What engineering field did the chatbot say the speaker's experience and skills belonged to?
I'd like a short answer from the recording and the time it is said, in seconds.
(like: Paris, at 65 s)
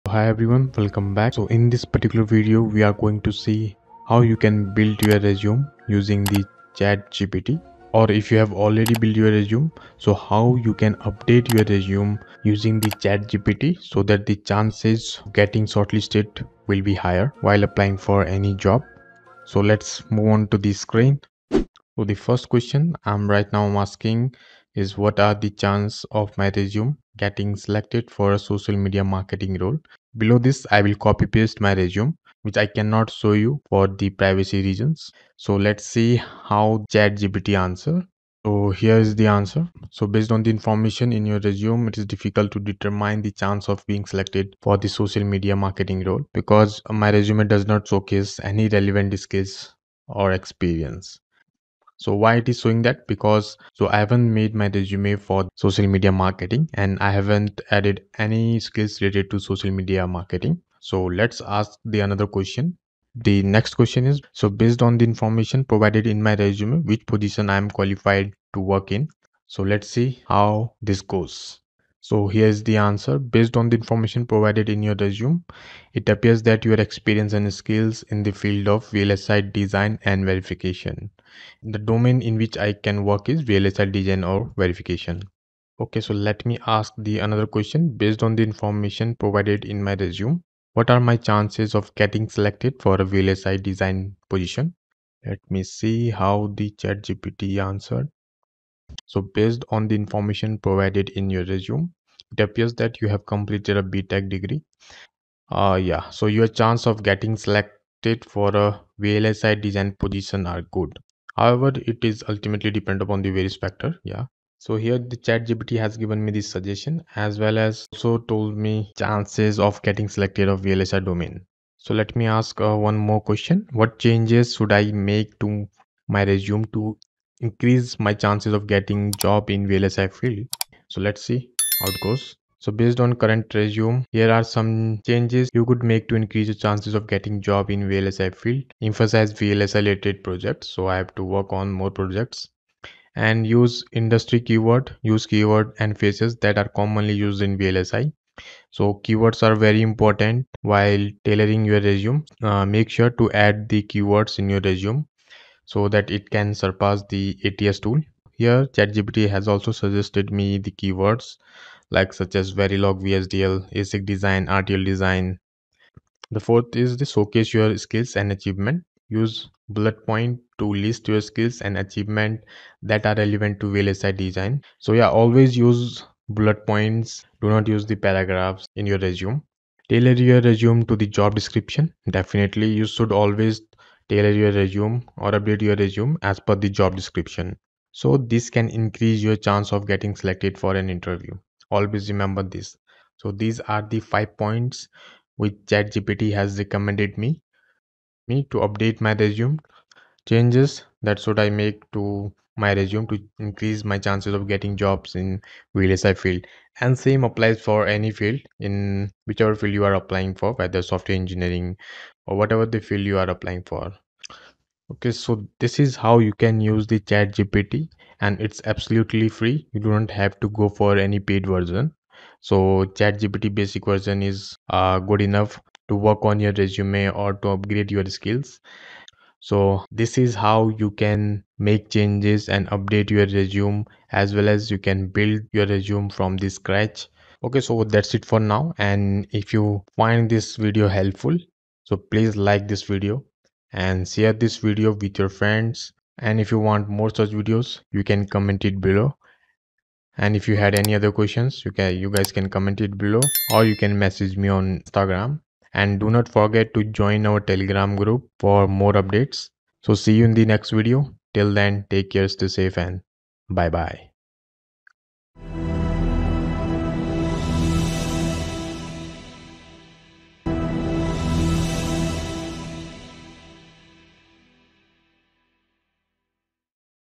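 VLSI design and verification, at 78 s.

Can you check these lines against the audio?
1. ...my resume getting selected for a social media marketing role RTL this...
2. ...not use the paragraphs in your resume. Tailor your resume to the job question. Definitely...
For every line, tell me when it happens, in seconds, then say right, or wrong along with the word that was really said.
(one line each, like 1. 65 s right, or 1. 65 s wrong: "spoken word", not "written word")
1. 26 s wrong: "Below", not "RTL"
2. 177 s wrong: "description", not "question".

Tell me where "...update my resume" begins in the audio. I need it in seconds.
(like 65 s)
198 s.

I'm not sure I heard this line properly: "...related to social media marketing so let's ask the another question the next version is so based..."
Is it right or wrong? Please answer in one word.
wrong.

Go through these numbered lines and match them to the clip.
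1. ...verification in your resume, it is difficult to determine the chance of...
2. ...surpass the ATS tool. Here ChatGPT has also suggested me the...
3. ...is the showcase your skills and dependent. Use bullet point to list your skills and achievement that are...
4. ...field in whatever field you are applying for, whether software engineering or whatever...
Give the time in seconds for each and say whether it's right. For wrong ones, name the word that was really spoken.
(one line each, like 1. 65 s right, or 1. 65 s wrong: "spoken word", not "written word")
1. 40 s wrong: "information", not "verification"
2. 156 s right
3. 166 s wrong: "achievement", not "dependent"
4. 208 s wrong: "whichever", not "whatever".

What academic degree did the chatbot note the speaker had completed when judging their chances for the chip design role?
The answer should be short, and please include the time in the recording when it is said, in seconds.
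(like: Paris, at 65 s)
BTech, at 103 s.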